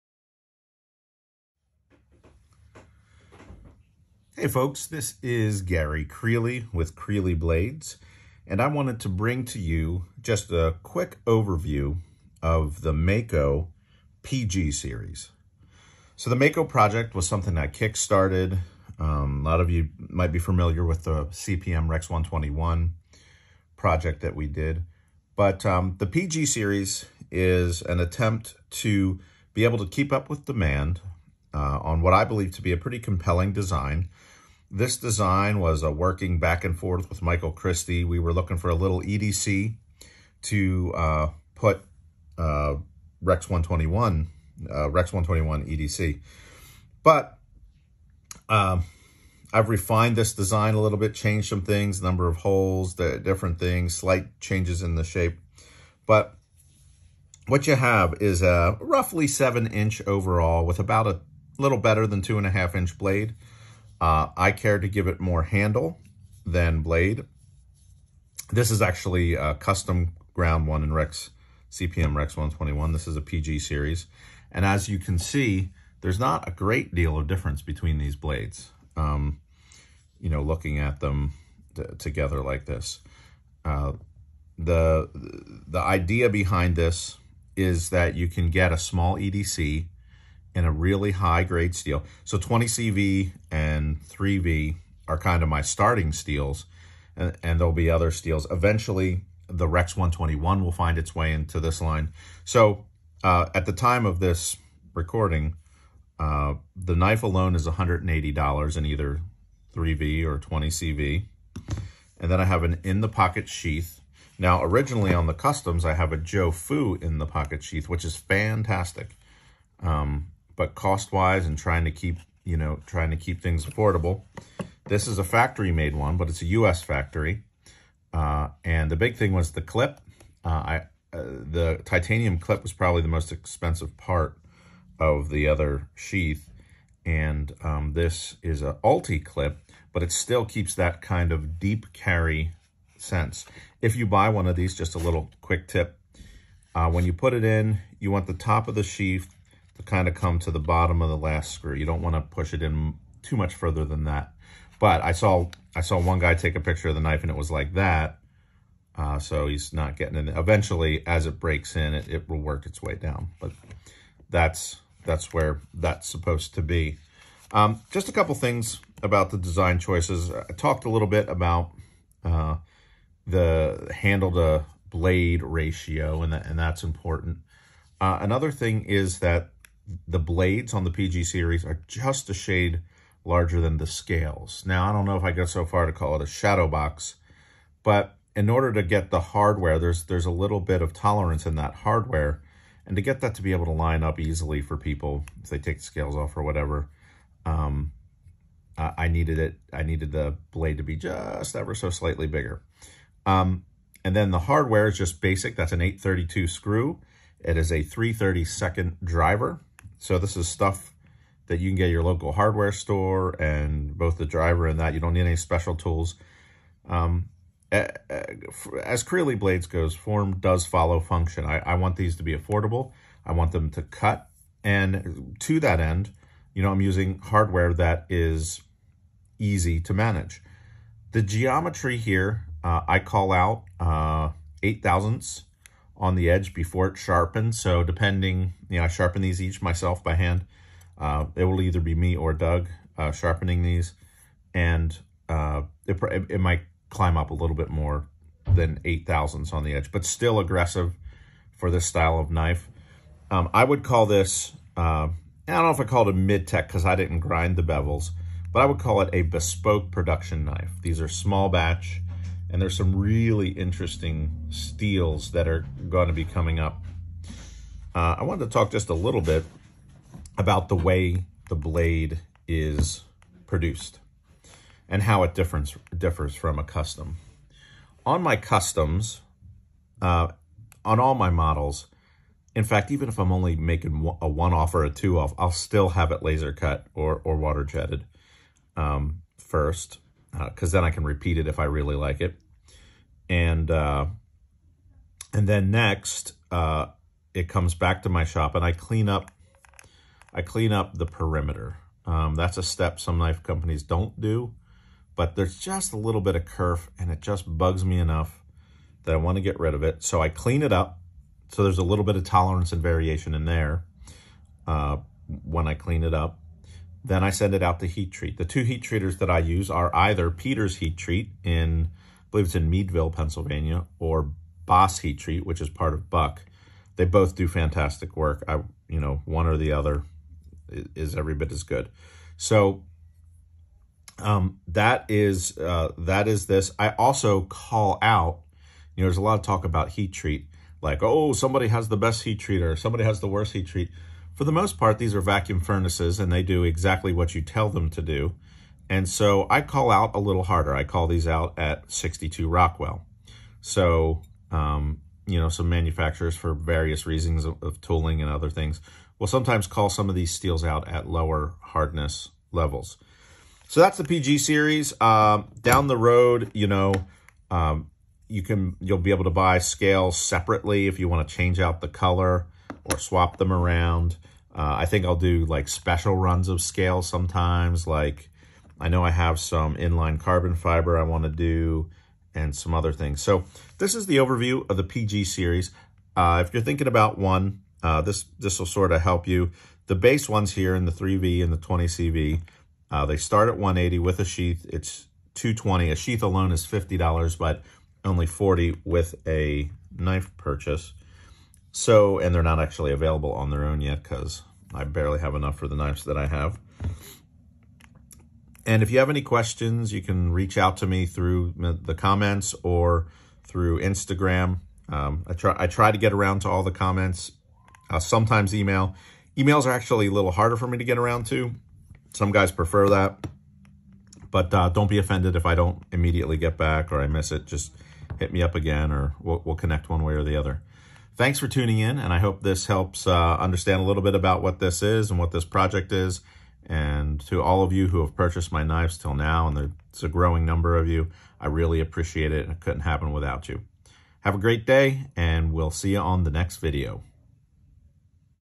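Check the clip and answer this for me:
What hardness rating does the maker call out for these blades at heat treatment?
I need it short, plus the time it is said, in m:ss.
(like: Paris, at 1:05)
62 Rockwell, at 5:51.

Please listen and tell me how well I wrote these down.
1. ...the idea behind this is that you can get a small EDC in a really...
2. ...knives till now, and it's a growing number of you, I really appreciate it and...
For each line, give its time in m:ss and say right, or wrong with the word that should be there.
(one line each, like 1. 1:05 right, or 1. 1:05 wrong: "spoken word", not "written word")
1. 1:25 right
2. 7:18 right.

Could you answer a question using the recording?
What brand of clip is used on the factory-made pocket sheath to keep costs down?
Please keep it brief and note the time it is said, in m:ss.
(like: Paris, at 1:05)
Ulticlip, at 2:18.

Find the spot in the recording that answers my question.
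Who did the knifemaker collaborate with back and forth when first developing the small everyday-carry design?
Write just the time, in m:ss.
0:37.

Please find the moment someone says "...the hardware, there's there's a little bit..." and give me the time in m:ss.
3:09.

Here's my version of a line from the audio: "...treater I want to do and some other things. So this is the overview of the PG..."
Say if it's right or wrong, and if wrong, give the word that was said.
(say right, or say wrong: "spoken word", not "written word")
wrong: "fiber", not "treater".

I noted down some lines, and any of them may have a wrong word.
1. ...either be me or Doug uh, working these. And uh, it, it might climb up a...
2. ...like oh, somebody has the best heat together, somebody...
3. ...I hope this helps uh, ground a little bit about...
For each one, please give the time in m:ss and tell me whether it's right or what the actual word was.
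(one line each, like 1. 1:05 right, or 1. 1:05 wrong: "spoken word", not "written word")
1. 4:01 wrong: "sharpening", not "working"
2. 5:40 wrong: "treater", not "together"
3. 7:12 wrong: "understand", not "ground".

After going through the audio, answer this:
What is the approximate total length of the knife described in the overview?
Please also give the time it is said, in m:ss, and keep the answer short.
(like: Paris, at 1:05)
7 inches, at 0:59.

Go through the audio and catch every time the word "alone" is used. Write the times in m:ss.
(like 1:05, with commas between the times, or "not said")
1:47, 6:36.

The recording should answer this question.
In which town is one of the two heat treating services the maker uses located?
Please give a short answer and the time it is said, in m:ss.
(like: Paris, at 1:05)
Meadville, Pennsylvania, at 5:22.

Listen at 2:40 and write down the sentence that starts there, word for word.
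Eventually, as it breaks in, it, it will work its way down.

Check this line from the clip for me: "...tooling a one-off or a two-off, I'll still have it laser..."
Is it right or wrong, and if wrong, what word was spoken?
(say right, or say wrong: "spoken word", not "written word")
wrong: "making", not "tooling".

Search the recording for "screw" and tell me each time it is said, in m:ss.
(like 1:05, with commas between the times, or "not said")
2:31, 3:26.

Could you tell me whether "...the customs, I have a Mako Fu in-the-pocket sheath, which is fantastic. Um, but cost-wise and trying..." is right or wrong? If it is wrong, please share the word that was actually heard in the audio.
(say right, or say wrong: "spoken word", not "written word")
wrong: "Joe", not "Mako".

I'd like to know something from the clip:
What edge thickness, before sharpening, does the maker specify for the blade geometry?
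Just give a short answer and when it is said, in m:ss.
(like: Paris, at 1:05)
8 thousandths, at 3:54.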